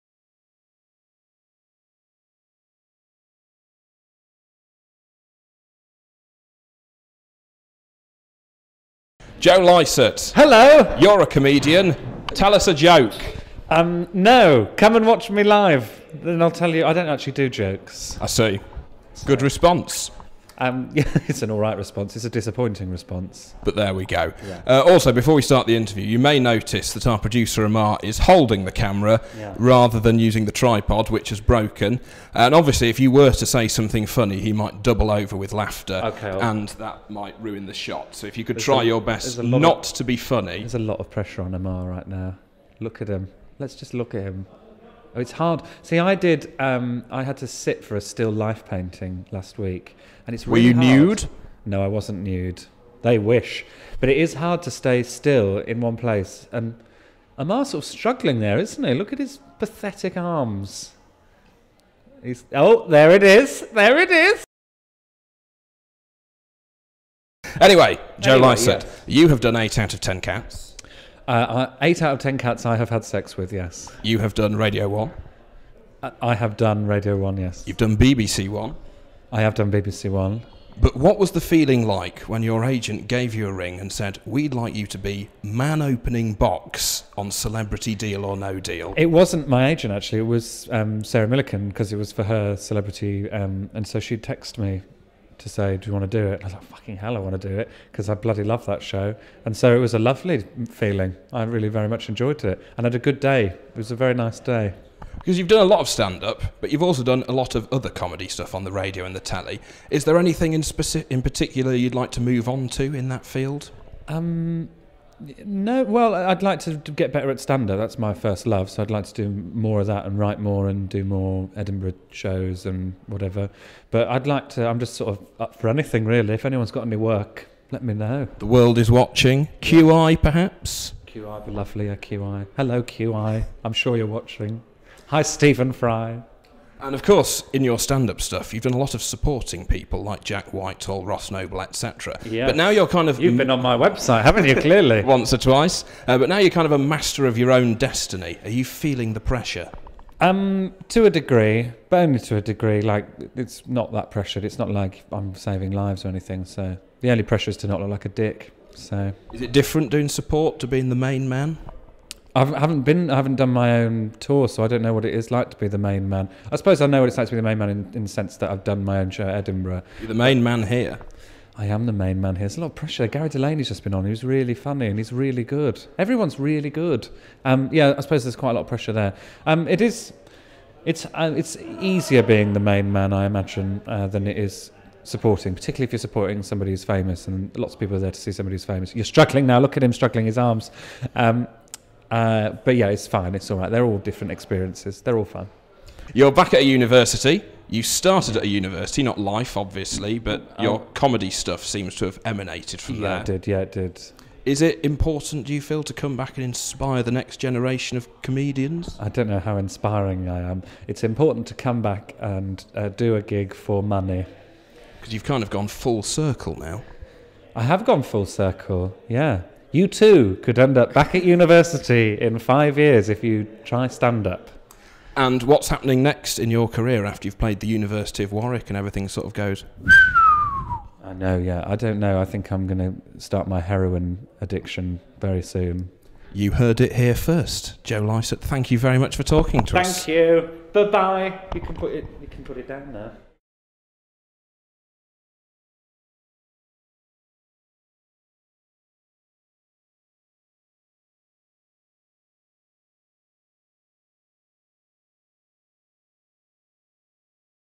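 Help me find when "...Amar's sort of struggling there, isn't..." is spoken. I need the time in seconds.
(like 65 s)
57 s.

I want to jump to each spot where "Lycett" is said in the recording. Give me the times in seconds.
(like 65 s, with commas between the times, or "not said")
9 s, 238 s.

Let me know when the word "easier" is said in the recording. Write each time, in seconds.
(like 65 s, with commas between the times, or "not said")
181 s.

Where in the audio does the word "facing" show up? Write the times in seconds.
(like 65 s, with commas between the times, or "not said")
not said.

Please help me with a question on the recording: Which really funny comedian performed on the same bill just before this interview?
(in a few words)
Gary Delaney.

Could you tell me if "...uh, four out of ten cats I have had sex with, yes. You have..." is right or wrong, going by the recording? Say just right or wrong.
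wrong.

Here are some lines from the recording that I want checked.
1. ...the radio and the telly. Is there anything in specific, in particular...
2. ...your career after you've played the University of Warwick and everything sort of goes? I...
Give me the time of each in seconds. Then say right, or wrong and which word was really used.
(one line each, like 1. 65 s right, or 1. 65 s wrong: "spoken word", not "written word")
1. 108 s right
2. 226 s right.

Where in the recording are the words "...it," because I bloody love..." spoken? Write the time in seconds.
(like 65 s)
97 s.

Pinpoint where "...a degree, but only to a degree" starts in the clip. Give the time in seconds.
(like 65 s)
151 s.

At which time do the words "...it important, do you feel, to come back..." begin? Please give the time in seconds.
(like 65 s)
204 s.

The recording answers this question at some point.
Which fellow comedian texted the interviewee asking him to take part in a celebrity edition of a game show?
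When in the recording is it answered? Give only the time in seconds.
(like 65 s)
91 s.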